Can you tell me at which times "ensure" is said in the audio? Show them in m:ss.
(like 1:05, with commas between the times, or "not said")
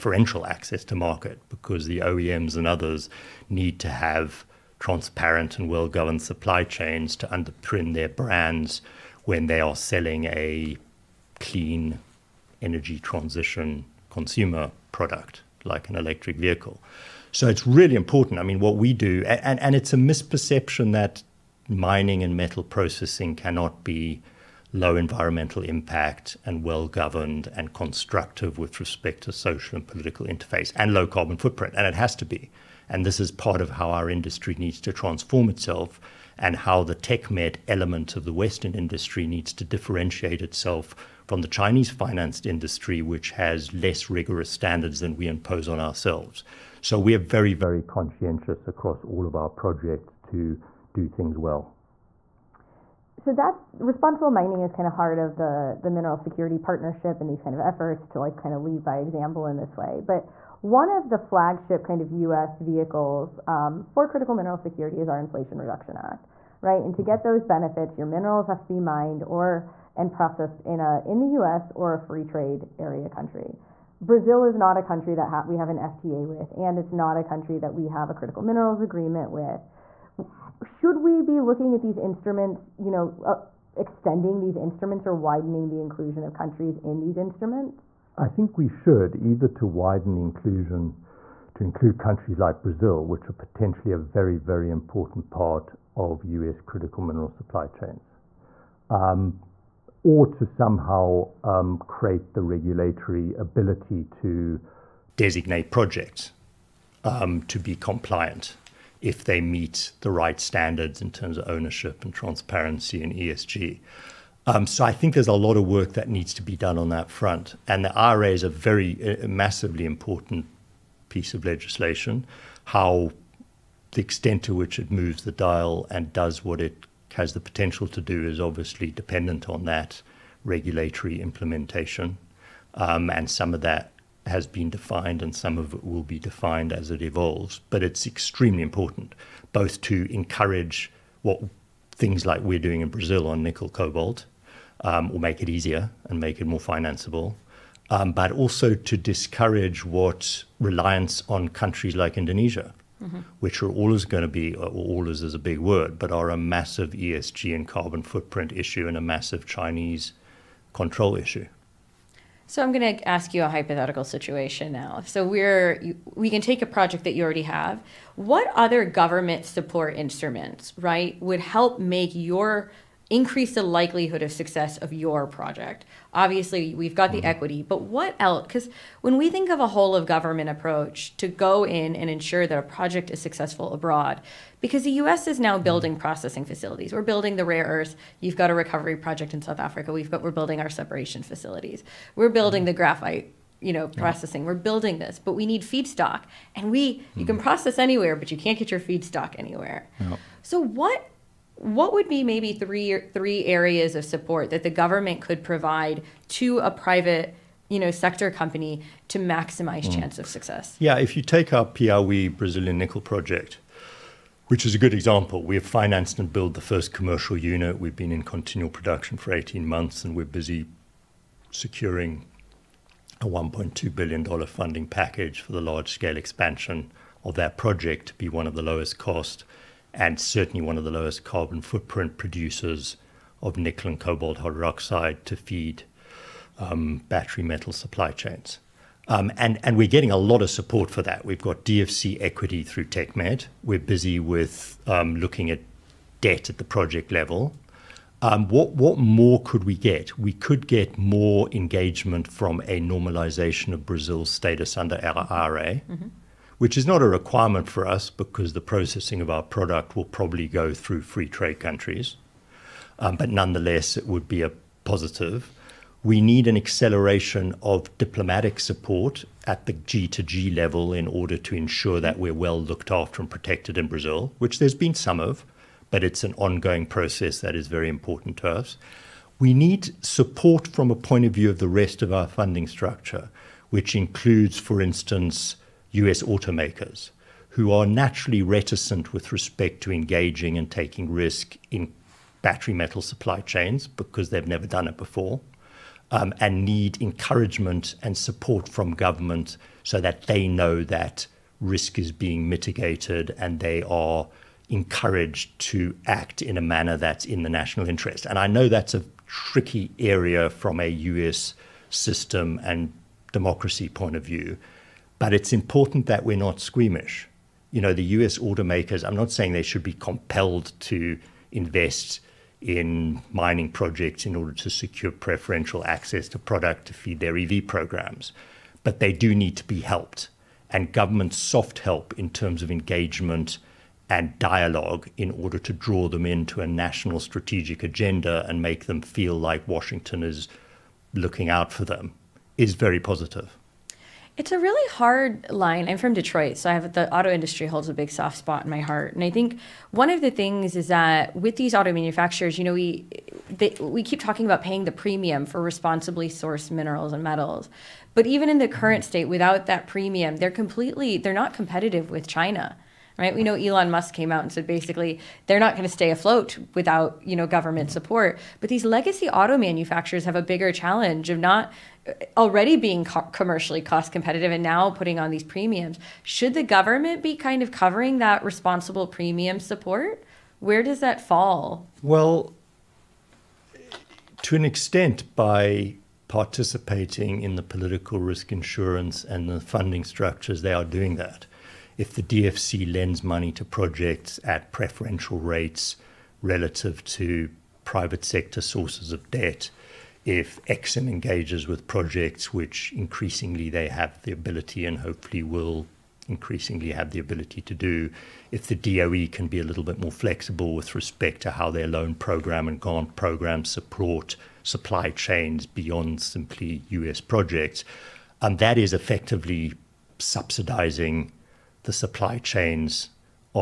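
3:02, 4:31.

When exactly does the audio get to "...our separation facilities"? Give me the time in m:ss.
3:10.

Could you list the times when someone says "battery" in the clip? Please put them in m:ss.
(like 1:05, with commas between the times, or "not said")
3:57, 4:52.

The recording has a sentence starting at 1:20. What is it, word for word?
Should we be looking at these instruments, you know, uh, extending these instruments or widening the inclusion of countries in these instruments?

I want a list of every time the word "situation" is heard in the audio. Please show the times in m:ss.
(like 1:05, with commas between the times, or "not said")
2:44.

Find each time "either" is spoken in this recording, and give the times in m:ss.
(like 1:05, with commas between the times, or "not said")
1:29.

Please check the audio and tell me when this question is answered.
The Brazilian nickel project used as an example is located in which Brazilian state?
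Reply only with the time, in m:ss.
3:31.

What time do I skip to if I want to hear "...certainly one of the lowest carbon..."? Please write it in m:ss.
3:50.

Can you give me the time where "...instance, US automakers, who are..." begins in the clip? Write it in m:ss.
4:44.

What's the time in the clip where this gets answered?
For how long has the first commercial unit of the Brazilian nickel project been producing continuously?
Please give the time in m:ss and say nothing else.
3:39.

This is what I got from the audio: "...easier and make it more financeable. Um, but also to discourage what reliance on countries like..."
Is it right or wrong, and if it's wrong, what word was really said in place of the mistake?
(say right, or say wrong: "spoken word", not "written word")
right.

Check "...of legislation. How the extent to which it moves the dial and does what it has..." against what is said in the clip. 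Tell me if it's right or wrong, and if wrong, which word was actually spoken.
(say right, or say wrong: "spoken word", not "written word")
right.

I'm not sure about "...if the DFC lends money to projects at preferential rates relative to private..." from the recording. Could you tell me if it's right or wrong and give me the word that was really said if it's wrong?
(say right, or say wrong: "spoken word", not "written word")
right.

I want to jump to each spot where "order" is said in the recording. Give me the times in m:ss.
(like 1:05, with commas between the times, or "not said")
4:31, 5:24, 5:35.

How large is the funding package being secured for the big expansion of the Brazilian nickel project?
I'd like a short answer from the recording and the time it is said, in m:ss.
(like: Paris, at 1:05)
$1.2 billion, at 3:43.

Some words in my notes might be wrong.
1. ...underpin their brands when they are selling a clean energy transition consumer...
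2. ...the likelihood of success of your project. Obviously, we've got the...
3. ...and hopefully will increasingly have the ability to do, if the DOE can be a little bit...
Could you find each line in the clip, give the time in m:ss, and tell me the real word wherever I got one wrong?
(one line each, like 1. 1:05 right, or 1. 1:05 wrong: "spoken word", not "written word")
1. 0:07 right
2. 2:53 right
3. 6:44 right.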